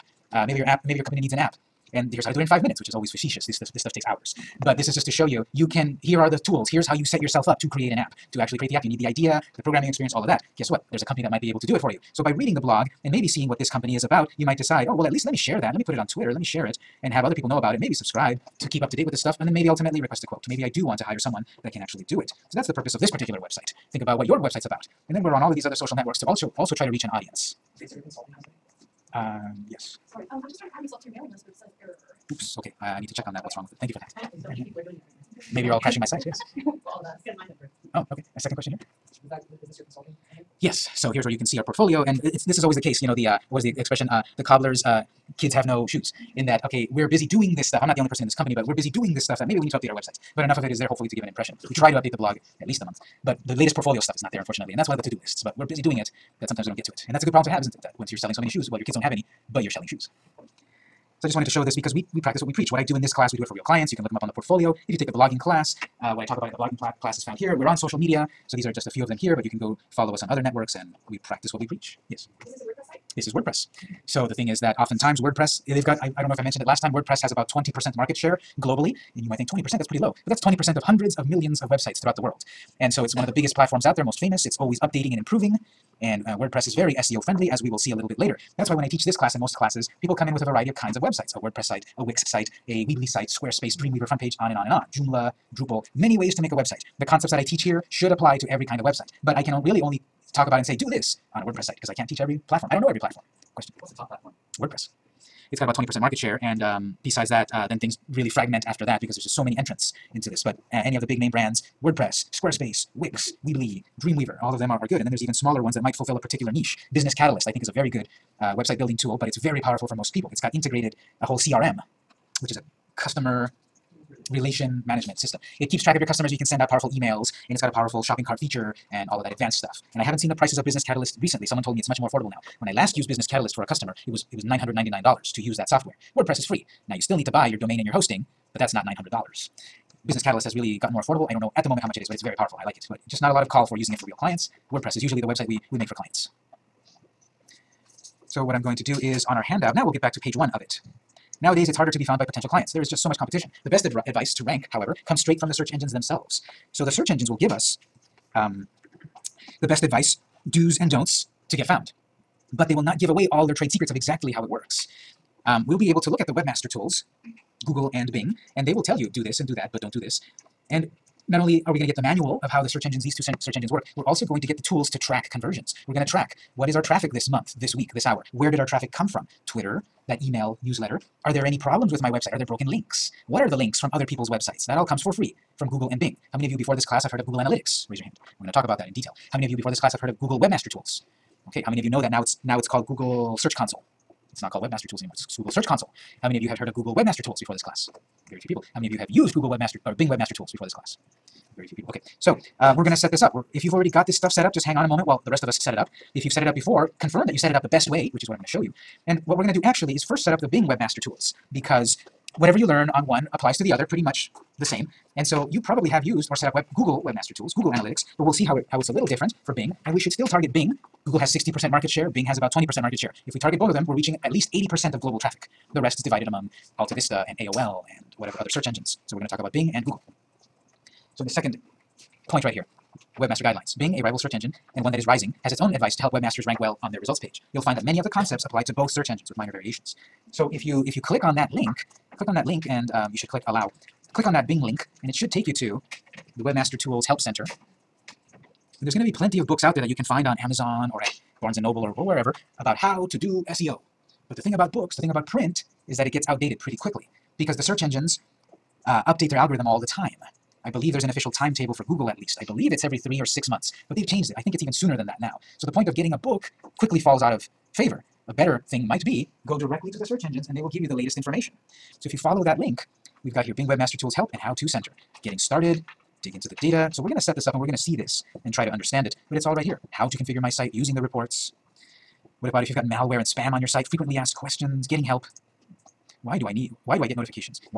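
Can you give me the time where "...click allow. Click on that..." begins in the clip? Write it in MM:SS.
04:03.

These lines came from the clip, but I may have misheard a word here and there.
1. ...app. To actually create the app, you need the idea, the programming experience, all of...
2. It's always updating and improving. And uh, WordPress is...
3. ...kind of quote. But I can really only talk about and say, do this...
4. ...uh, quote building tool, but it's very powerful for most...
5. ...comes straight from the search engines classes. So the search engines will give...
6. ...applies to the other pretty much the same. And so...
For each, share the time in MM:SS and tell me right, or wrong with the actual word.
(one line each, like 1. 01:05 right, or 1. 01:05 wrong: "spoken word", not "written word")
1. 00:07 right
2. 01:24 right
3. 01:38 wrong: "website", not "quote"
4. 01:58 wrong: "website", not "quote"
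5. 02:35 wrong: "themselves", not "classes"
6. 03:33 right.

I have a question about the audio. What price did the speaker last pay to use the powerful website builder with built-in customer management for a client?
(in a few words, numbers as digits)
$999.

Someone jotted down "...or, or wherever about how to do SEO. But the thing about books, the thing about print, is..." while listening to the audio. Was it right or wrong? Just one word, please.
right.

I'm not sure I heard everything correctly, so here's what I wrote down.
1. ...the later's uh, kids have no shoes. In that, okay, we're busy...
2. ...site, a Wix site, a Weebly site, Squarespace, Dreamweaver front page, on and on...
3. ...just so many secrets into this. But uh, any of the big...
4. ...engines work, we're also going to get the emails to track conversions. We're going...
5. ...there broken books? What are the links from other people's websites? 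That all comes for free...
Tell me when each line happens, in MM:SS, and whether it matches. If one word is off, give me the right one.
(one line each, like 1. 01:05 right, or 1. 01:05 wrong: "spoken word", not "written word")
1. 00:44 wrong: "cobbler", not "later"
2. 01:31 right
3. 01:49 wrong: "entrants", not "secrets"
4. 02:53 wrong: "tools", not "emails"
5. 03:02 wrong: "links", not "books".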